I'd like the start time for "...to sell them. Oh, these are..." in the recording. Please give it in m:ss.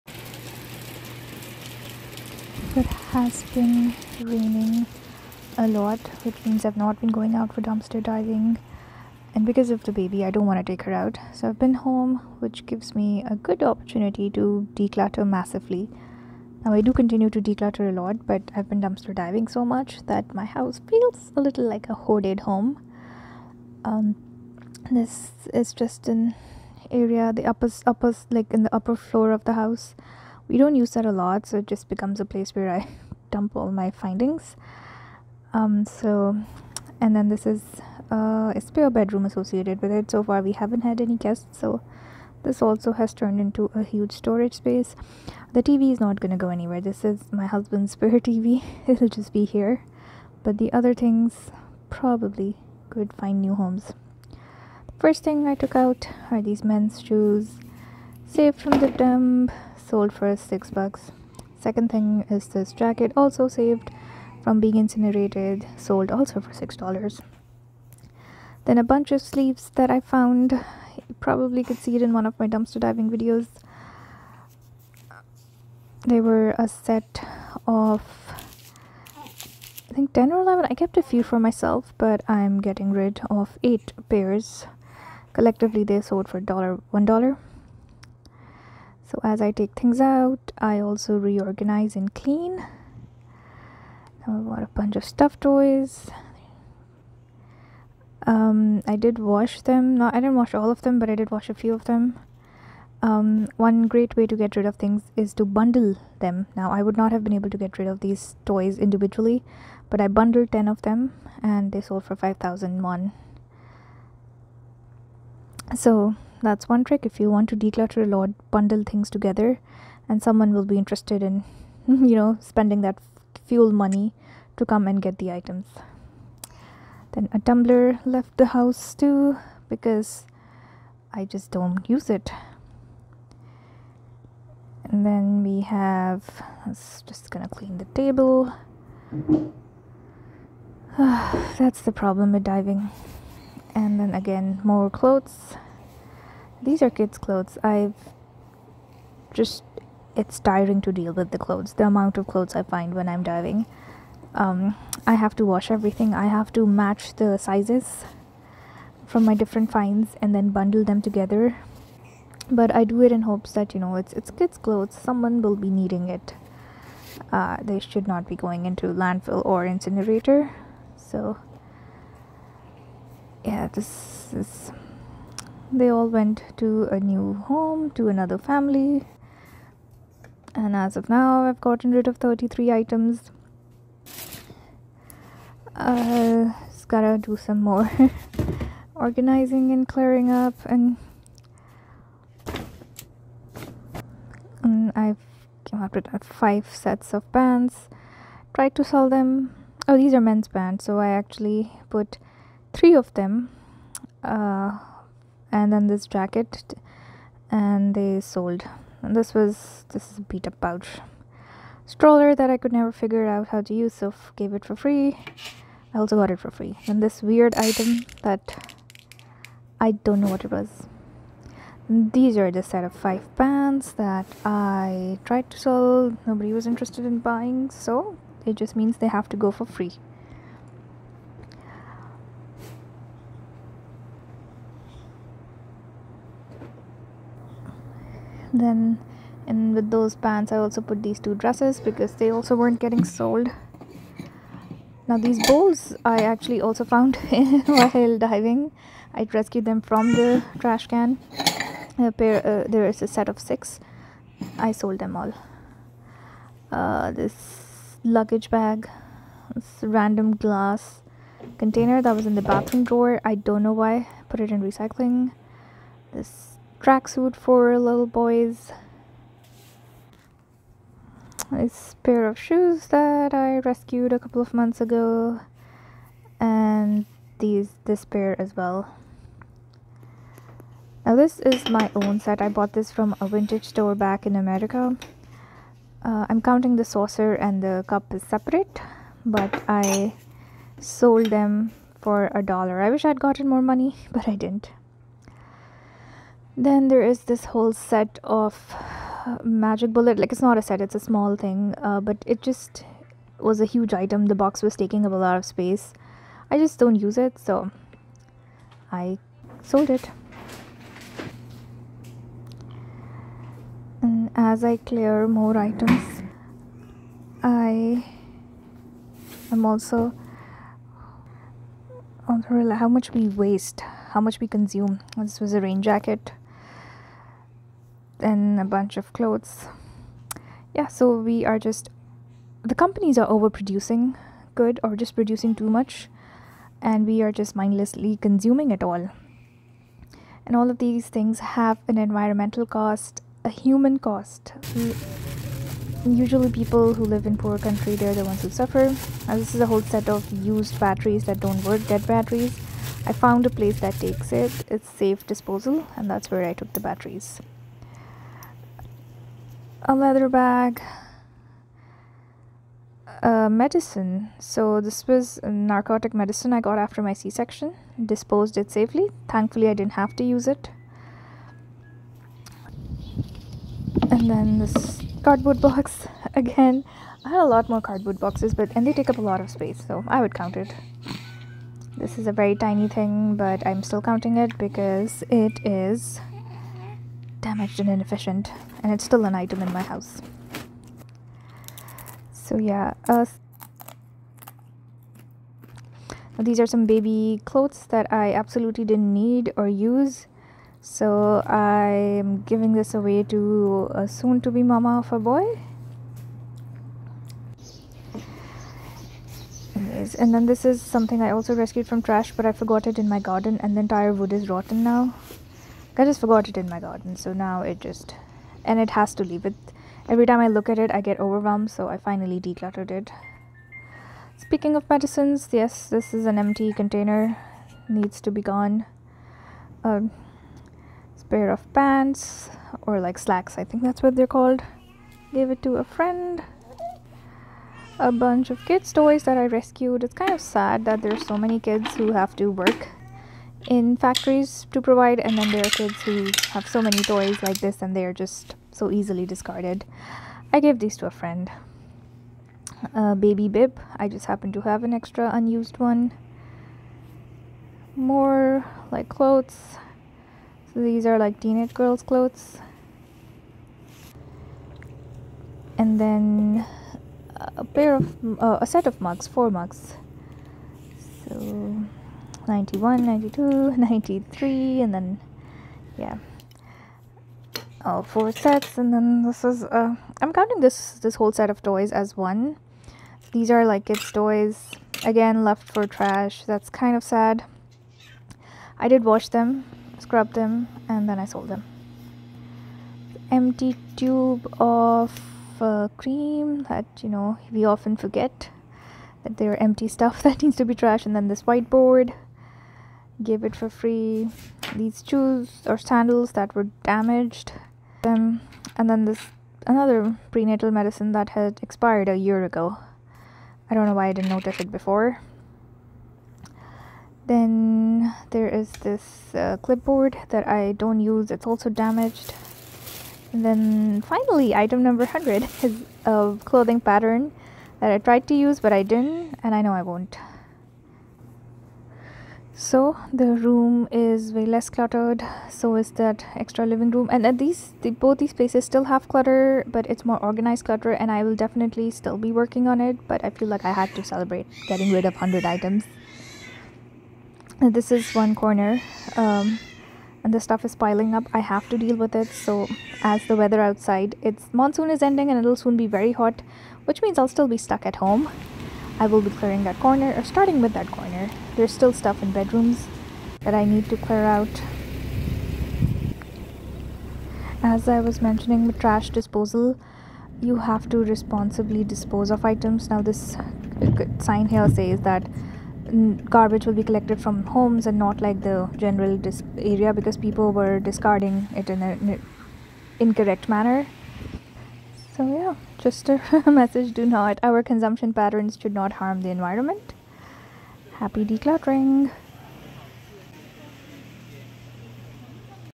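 3:18.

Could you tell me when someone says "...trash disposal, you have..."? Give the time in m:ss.
9:28.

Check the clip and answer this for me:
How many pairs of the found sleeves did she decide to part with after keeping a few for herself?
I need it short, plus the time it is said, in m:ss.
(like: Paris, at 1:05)
8, at 1:23.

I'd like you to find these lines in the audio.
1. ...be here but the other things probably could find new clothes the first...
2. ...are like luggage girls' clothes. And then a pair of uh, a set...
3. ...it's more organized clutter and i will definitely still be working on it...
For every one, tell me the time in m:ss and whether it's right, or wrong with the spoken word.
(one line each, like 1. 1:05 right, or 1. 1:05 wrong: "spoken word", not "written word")
1. 0:49 wrong: "homes", not "clothes"
2. 7:41 wrong: "teenage", not "luggage"
3. 8:59 right.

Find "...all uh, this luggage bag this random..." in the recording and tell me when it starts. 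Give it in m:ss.
4:15.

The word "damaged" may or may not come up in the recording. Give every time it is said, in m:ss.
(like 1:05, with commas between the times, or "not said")
6:27, 8:26, 8:41.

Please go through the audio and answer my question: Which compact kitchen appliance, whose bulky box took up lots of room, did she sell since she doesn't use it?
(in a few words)
Magic Bullet.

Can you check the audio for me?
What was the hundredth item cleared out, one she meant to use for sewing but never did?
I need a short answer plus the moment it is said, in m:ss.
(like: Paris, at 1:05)
A clothing pattern, at 8:46.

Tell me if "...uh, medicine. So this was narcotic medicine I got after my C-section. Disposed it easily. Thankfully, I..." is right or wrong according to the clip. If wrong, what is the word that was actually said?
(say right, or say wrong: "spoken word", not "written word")
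wrong: "safely", not "easily".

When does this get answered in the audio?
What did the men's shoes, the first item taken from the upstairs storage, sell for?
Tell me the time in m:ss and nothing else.
1:00.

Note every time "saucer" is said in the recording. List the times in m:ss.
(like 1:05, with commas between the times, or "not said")
4:46.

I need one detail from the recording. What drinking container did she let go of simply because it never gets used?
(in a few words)
A tumbler.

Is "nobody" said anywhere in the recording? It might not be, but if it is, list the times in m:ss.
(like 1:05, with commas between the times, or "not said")
3:46.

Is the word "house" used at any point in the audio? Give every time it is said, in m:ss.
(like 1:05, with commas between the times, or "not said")
0:20, 0:29, 2:08, 6:29.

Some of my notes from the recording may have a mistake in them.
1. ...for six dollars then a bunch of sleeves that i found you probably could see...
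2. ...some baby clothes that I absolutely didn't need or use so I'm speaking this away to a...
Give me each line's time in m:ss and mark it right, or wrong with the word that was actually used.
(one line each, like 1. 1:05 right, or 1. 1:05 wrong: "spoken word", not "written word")
1. 1:06 right
2. 6:36 wrong: "giving", not "speaking".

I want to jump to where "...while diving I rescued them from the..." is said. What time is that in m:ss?
4:07.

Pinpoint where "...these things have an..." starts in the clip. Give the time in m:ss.
5:40.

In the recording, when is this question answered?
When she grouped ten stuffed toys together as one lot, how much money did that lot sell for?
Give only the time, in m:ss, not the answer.
1:52.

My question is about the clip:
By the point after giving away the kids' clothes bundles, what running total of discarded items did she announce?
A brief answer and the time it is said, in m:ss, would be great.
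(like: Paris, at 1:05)
33, at 3:02.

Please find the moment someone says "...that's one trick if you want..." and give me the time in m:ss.
1:56.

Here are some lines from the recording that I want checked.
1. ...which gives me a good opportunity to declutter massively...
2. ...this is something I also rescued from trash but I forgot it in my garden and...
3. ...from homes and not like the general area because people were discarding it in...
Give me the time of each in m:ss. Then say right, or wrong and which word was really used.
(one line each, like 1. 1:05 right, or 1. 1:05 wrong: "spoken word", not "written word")
1. 0:12 right
2. 6:50 right
3. 9:37 right.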